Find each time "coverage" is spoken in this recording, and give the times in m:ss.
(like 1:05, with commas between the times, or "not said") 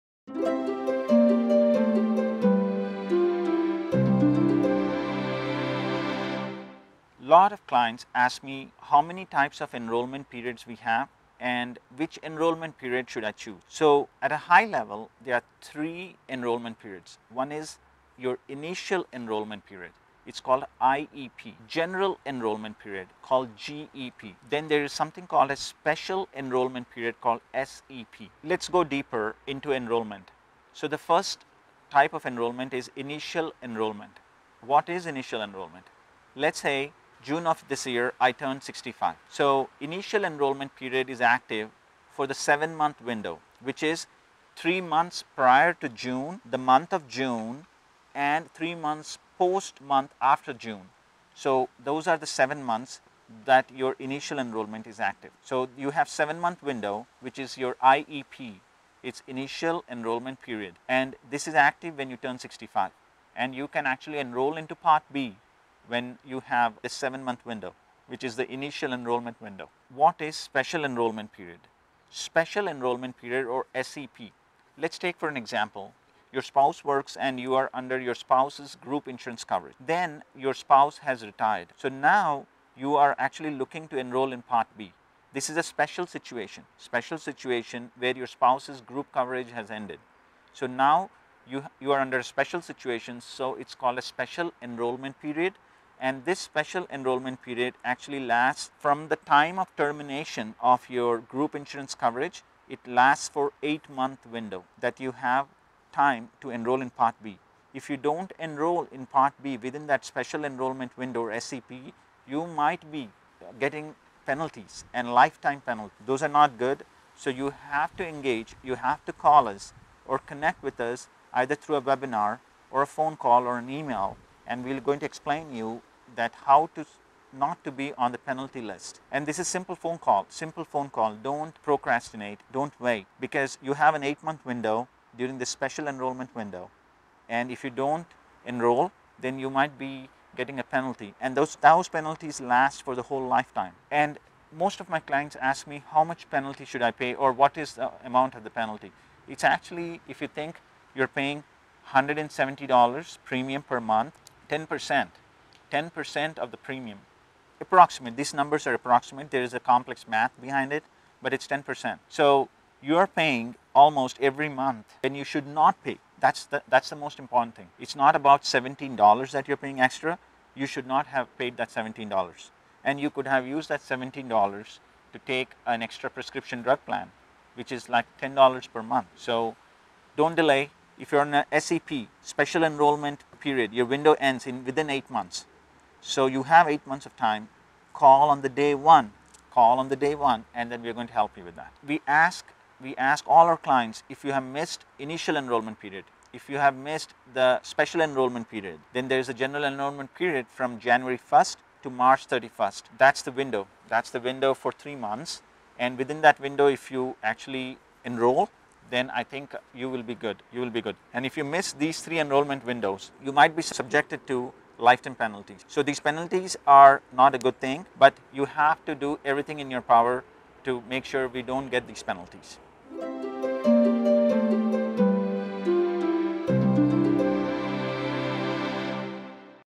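1:19, 1:29, 1:41.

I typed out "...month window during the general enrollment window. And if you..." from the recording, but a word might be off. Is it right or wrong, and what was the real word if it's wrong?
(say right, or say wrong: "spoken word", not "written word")
wrong: "special", not "general".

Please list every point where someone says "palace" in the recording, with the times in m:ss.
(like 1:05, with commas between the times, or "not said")
not said.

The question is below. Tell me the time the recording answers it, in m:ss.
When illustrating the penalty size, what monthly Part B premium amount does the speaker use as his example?
2:31.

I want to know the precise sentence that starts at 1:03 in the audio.
And you can actually enroll into part B when you have a seven month window, which is the initial enrollment window.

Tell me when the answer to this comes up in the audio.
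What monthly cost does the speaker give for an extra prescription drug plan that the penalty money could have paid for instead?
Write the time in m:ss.
2:58.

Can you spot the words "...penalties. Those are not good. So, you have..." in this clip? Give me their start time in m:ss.
1:55.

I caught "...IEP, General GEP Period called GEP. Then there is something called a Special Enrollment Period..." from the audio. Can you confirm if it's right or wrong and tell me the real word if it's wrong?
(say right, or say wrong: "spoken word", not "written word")
wrong: "Enrollment", not "GEP".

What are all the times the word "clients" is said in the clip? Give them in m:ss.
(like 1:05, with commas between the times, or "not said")
0:07, 2:24, 3:13.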